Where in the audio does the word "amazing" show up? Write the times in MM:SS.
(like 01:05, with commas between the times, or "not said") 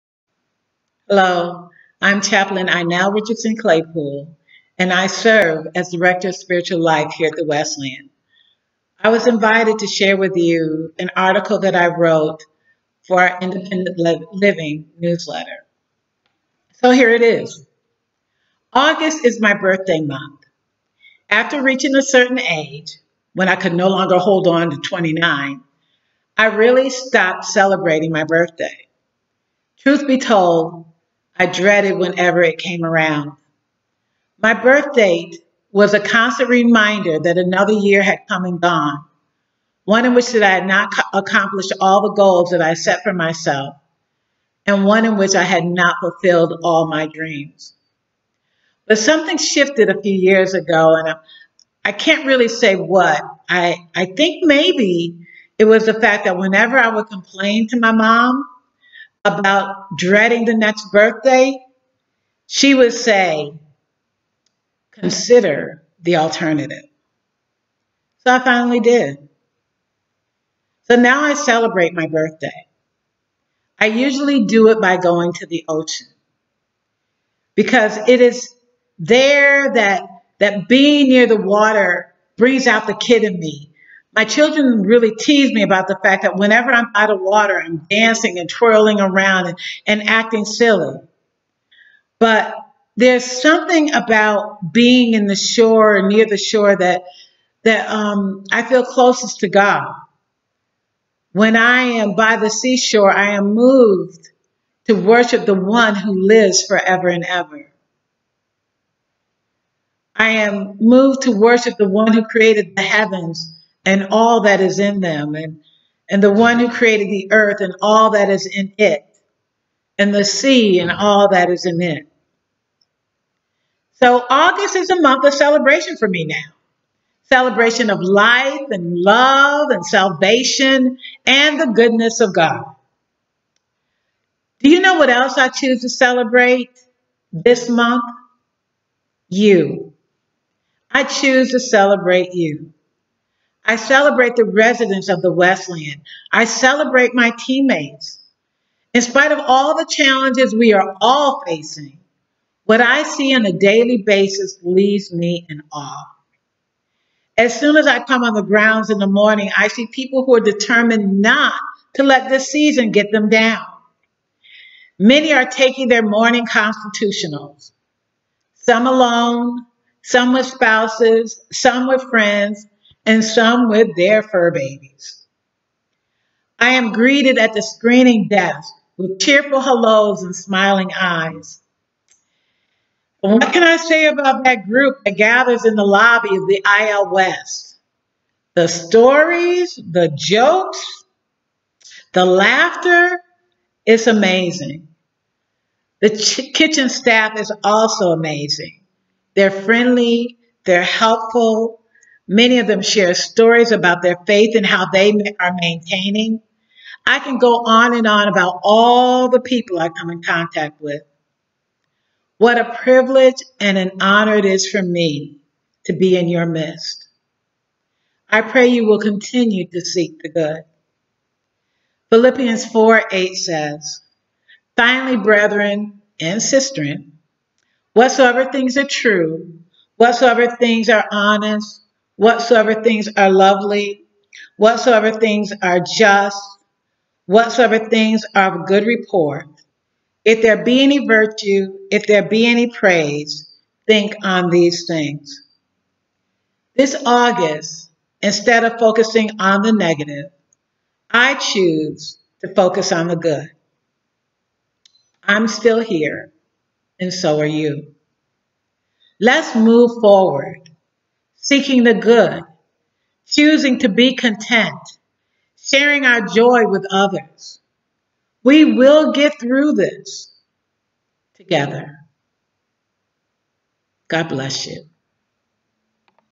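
03:14, 03:18.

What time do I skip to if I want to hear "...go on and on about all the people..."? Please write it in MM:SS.
03:27.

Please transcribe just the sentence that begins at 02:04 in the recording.
So August is a month of celebration for me now.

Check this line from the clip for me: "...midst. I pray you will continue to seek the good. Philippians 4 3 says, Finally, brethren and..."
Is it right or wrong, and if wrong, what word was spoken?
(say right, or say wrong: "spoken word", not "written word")
wrong: "8", not "3".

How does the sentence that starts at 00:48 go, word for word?
But something shifted a few years ago, and I, I can't really say what.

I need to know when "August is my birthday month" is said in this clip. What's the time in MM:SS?
00:18.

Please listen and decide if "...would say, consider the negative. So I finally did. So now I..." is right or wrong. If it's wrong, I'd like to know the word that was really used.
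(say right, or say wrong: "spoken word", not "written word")
wrong: "alternative", not "negative".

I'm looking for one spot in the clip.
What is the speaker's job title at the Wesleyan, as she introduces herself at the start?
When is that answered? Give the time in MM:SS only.
00:05.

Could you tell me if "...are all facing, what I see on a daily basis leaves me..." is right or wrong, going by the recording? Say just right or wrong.
right.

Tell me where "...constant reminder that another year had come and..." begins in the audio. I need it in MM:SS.
00:35.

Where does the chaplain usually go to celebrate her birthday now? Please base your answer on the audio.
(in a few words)
The ocean.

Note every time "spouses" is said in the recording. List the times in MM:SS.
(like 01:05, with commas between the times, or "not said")
02:50.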